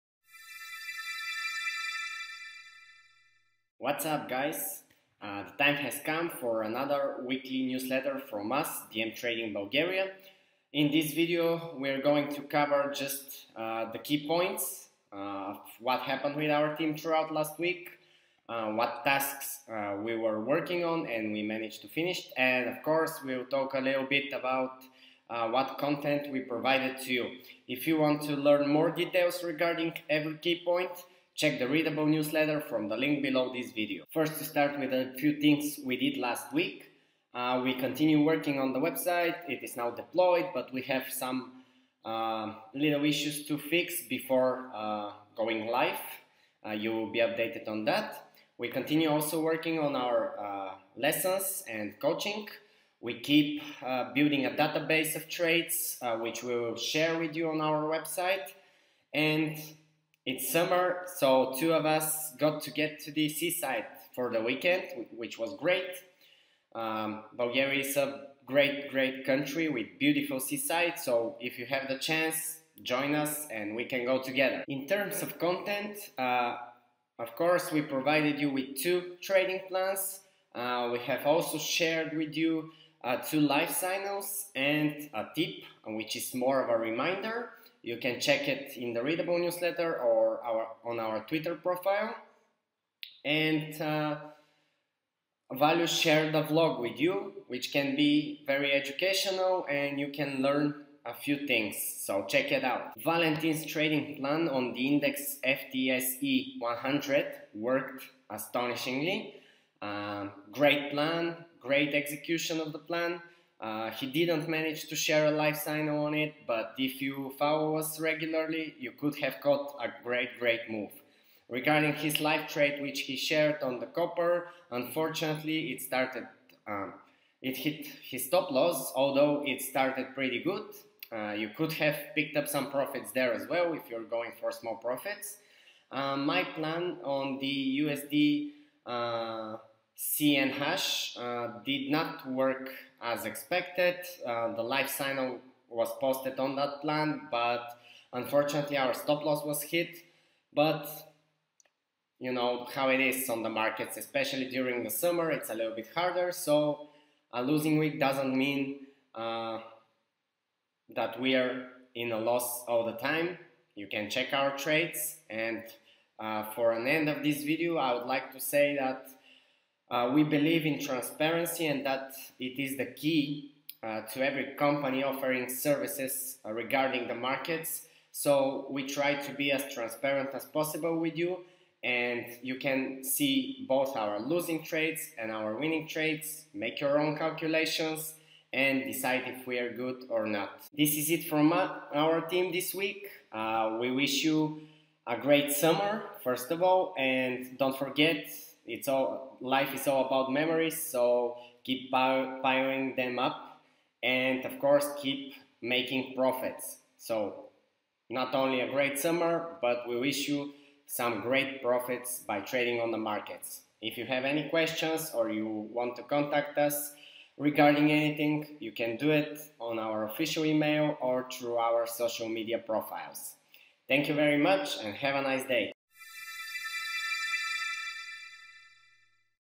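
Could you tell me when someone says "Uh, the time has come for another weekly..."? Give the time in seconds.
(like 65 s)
5 s.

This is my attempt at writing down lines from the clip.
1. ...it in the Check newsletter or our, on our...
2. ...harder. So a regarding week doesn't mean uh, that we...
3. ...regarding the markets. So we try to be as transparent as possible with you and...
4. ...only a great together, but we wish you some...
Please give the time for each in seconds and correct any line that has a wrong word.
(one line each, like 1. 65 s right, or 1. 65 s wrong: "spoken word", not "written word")
1. 88 s wrong: "Readable", not "Check"
2. 155 s wrong: "losing", not "regarding"
3. 176 s right
4. 208 s wrong: "summer", not "together".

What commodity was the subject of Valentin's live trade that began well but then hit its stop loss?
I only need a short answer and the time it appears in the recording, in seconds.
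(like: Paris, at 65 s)
Copper, at 123 s.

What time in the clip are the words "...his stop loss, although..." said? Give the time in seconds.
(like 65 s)
128 s.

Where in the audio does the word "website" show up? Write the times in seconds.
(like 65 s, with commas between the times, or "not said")
38 s, 57 s.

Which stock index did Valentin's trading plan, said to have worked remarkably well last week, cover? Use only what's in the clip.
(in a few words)
FTSE 100.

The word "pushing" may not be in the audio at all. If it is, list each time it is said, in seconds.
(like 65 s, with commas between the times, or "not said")
not said.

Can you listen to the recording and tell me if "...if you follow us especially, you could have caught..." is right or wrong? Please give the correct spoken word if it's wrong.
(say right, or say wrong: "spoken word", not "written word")
wrong: "regularly", not "especially".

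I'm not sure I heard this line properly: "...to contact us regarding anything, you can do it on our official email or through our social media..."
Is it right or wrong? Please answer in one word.
right.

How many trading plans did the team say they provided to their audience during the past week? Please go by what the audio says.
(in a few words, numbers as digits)
2.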